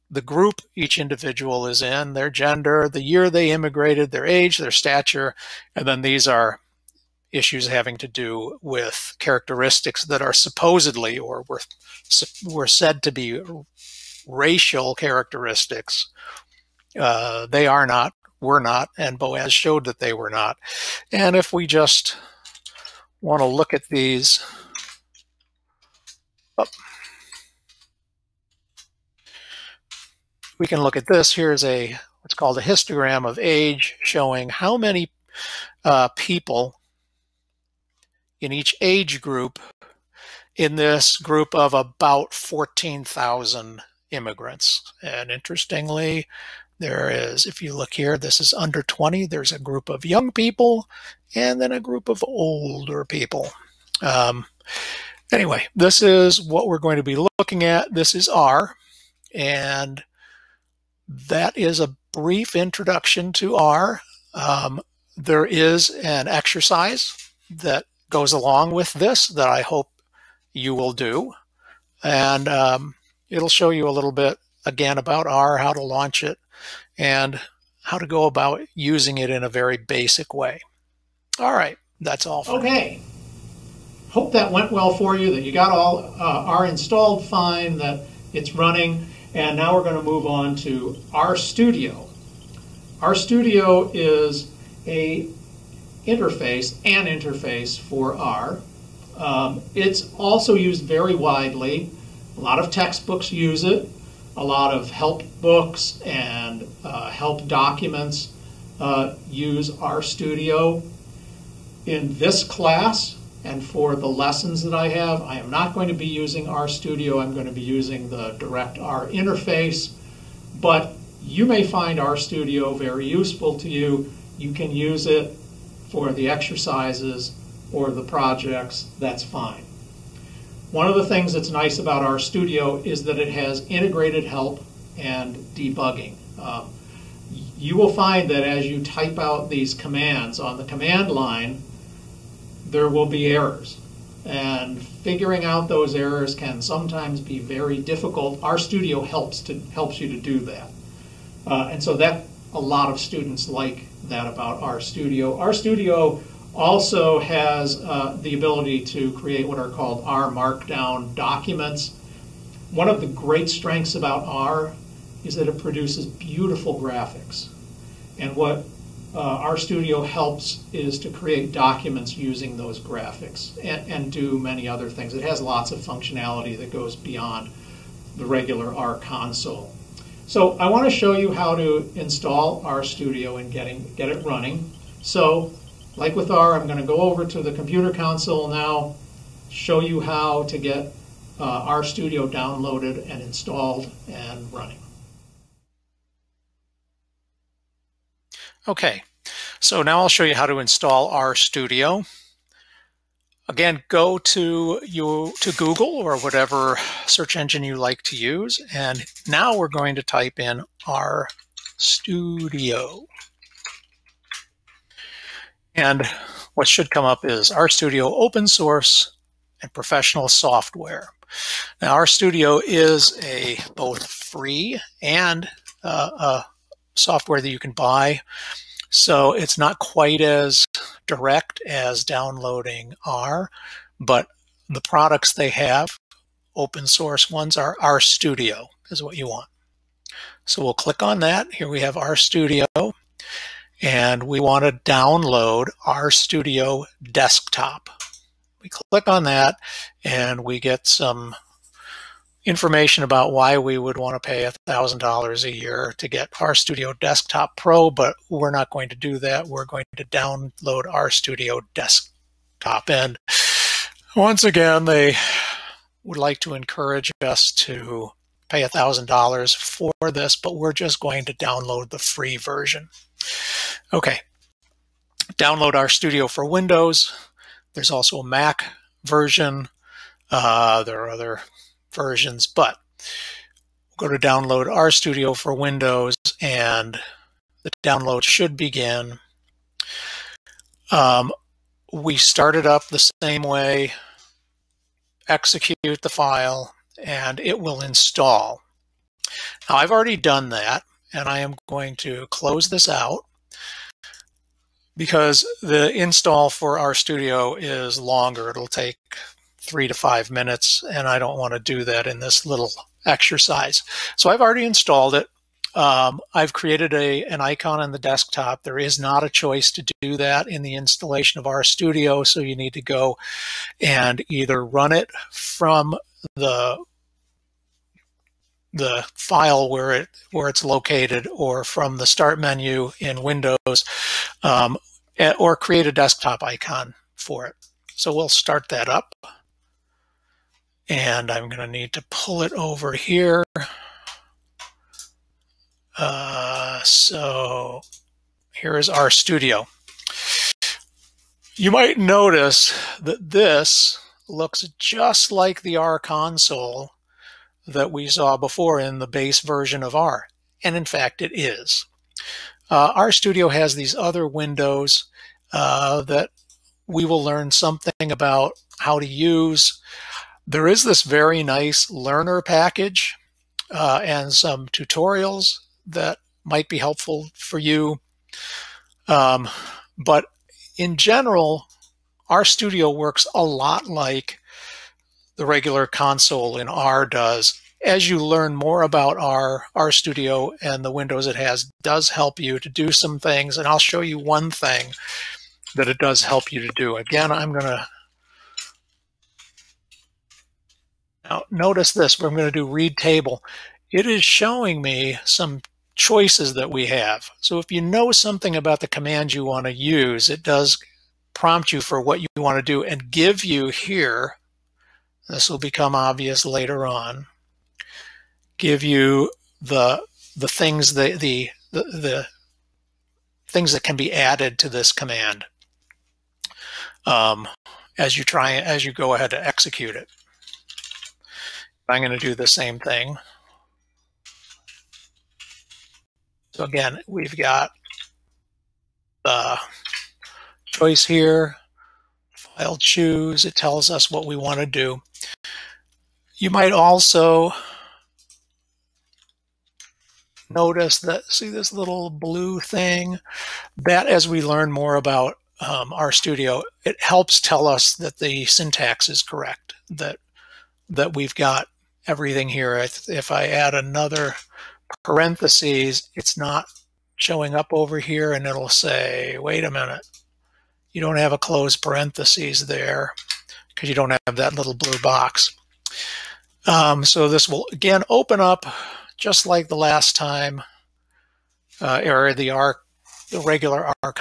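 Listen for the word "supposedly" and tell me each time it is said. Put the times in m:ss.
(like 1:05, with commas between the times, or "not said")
0:10.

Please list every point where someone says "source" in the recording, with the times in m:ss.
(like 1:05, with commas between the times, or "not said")
3:38, 3:56.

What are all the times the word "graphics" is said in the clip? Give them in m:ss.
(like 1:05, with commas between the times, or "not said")
2:46, 2:52.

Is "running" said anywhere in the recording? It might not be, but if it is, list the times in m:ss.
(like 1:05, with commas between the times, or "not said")
1:28, 3:04, 3:14.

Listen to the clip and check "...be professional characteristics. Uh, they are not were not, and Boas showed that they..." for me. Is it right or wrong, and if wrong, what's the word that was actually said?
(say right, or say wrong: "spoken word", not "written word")
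wrong: "racial", not "professional".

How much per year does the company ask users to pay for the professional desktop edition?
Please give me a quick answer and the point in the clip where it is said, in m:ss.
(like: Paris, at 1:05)
$1,000, at 4:14.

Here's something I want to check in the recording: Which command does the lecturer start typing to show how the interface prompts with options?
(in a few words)
read table.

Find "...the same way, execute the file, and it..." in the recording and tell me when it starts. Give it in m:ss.
4:52.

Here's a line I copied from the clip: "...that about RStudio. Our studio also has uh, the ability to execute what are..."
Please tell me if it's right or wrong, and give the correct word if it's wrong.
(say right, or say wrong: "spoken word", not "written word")
wrong: "create", not "execute".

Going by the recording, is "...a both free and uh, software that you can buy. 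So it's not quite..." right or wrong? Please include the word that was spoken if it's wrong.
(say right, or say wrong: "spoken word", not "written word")
right.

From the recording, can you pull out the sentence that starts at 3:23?
Again, go to you to Google or whatever search engine you like to use, and now we're going to type in RStudio.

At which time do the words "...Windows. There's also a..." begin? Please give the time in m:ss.
4:36.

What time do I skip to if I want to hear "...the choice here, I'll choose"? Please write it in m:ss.
7:19.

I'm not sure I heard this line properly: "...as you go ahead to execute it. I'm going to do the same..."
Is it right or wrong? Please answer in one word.
right.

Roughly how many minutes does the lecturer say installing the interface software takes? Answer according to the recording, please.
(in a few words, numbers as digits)
3 to 5 minutes.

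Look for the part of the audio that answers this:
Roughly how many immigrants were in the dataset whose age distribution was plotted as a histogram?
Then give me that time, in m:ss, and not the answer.
0:42.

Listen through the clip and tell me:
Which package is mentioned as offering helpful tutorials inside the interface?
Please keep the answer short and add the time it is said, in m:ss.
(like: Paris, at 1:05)
learnr, at 6:11.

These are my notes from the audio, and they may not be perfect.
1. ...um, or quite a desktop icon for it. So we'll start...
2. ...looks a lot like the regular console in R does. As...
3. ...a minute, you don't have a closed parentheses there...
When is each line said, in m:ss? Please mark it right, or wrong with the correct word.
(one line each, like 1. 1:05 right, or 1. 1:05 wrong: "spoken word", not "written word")
1. 5:34 wrong: "create", not "quite"
2. 6:22 wrong: "works", not "looks"
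3. 7:49 right.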